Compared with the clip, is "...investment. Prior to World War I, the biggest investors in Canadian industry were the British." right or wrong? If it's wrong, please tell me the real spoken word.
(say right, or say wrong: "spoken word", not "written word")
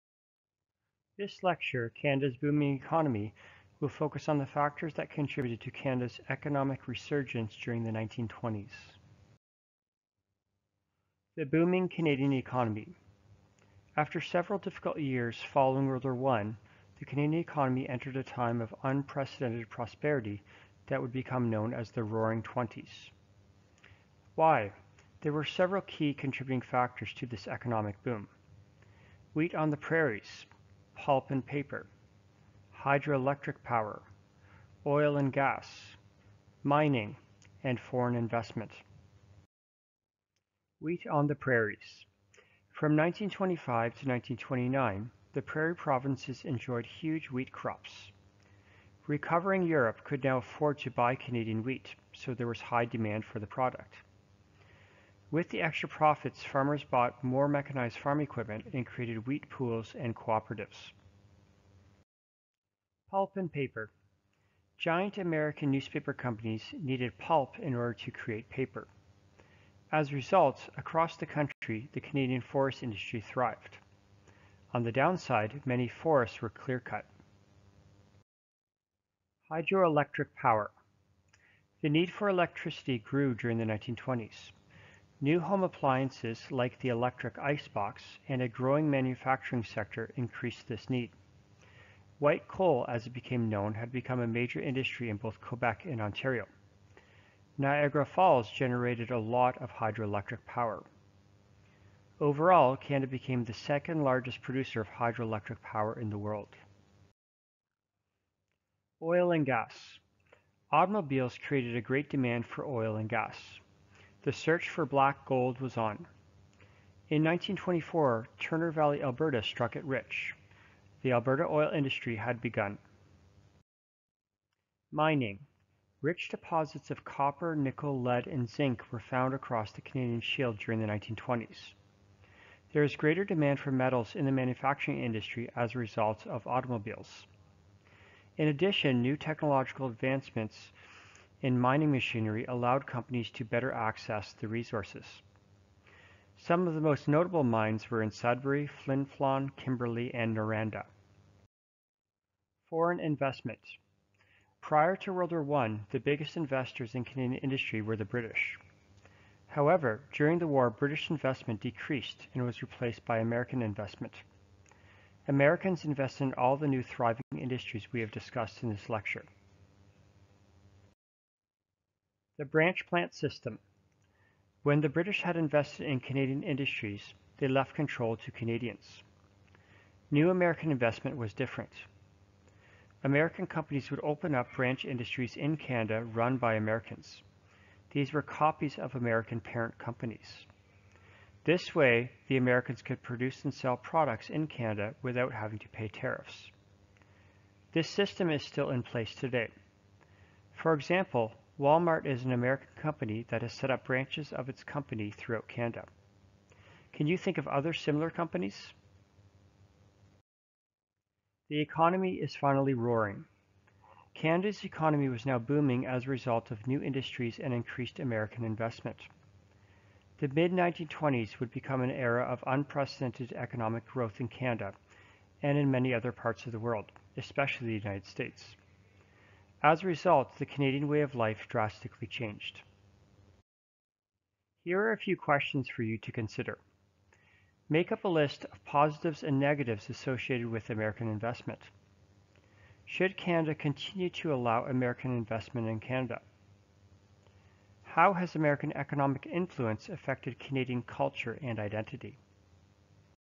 right.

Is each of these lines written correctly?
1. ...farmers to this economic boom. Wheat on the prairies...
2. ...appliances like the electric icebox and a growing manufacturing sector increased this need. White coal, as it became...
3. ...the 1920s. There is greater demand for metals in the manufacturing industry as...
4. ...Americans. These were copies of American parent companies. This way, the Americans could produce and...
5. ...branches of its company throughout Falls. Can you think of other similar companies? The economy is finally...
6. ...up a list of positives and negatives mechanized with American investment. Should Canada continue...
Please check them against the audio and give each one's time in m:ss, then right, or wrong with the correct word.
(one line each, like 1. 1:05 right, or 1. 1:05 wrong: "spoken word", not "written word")
1. 0:26 wrong: "factors", not "farmers"
2. 1:25 right
3. 2:10 right
4. 3:06 right
5. 3:23 wrong: "Canada", not "Falls"
6. 3:57 wrong: "associated", not "mechanized".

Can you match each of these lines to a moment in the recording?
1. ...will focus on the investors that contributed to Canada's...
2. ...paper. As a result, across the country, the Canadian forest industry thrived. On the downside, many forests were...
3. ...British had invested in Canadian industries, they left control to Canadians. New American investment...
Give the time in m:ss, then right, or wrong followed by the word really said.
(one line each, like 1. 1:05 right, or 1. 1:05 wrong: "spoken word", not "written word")
1. 0:03 wrong: "factors", not "investors"
2. 1:08 right
3. 2:54 right.